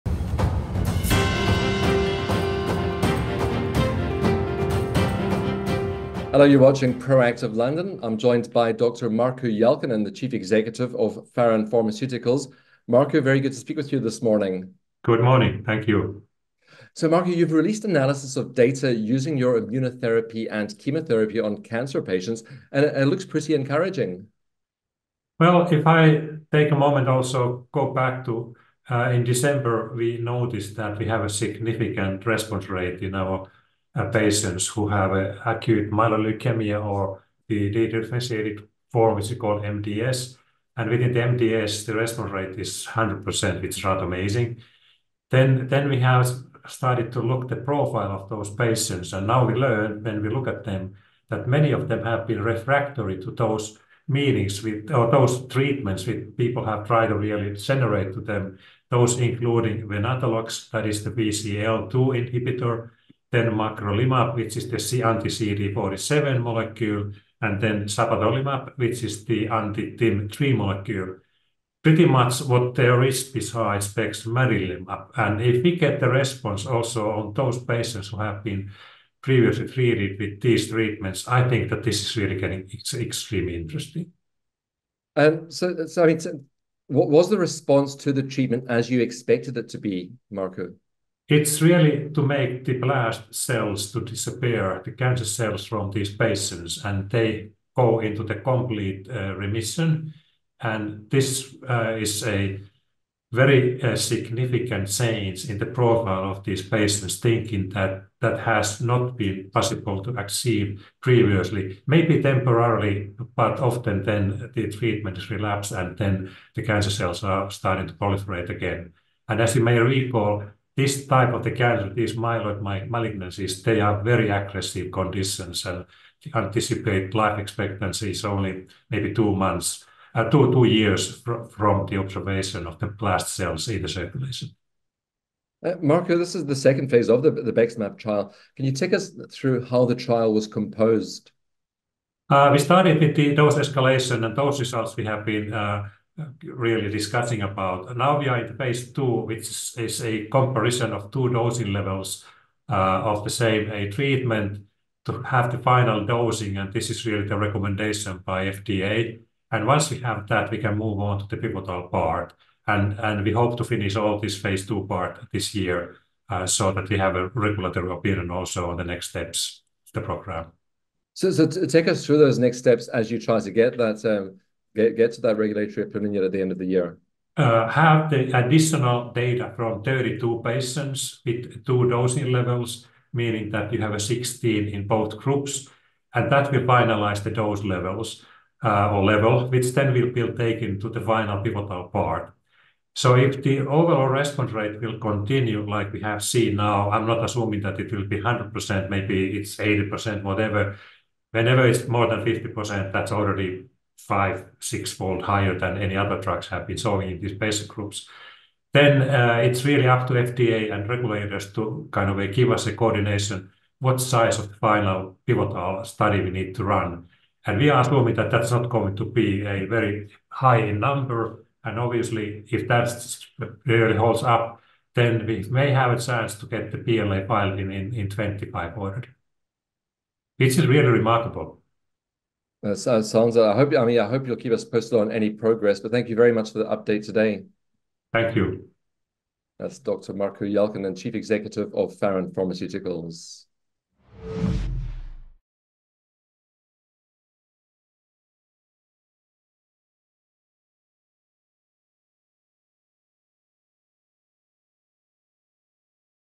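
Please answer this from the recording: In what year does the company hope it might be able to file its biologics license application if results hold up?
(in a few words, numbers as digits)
2025.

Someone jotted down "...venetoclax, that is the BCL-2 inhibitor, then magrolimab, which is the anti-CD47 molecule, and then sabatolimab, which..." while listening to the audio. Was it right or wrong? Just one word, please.
right.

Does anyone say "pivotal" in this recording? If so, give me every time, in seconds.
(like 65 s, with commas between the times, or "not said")
161 s, 191 s, 215 s.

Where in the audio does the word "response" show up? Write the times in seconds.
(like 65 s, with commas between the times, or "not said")
32 s, 41 s, 76 s, 87 s, 194 s.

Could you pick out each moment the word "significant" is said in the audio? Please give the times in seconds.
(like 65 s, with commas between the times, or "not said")
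31 s, 103 s.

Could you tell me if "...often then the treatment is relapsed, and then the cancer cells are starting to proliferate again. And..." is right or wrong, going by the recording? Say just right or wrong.
right.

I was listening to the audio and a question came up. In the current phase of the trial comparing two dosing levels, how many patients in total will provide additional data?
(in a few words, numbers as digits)
32.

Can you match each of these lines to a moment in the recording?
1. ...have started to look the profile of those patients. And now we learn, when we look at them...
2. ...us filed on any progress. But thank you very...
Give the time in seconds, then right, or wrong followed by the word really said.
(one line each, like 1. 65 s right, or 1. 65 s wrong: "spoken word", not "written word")
1. 45 s right
2. 234 s wrong: "posted", not "filed".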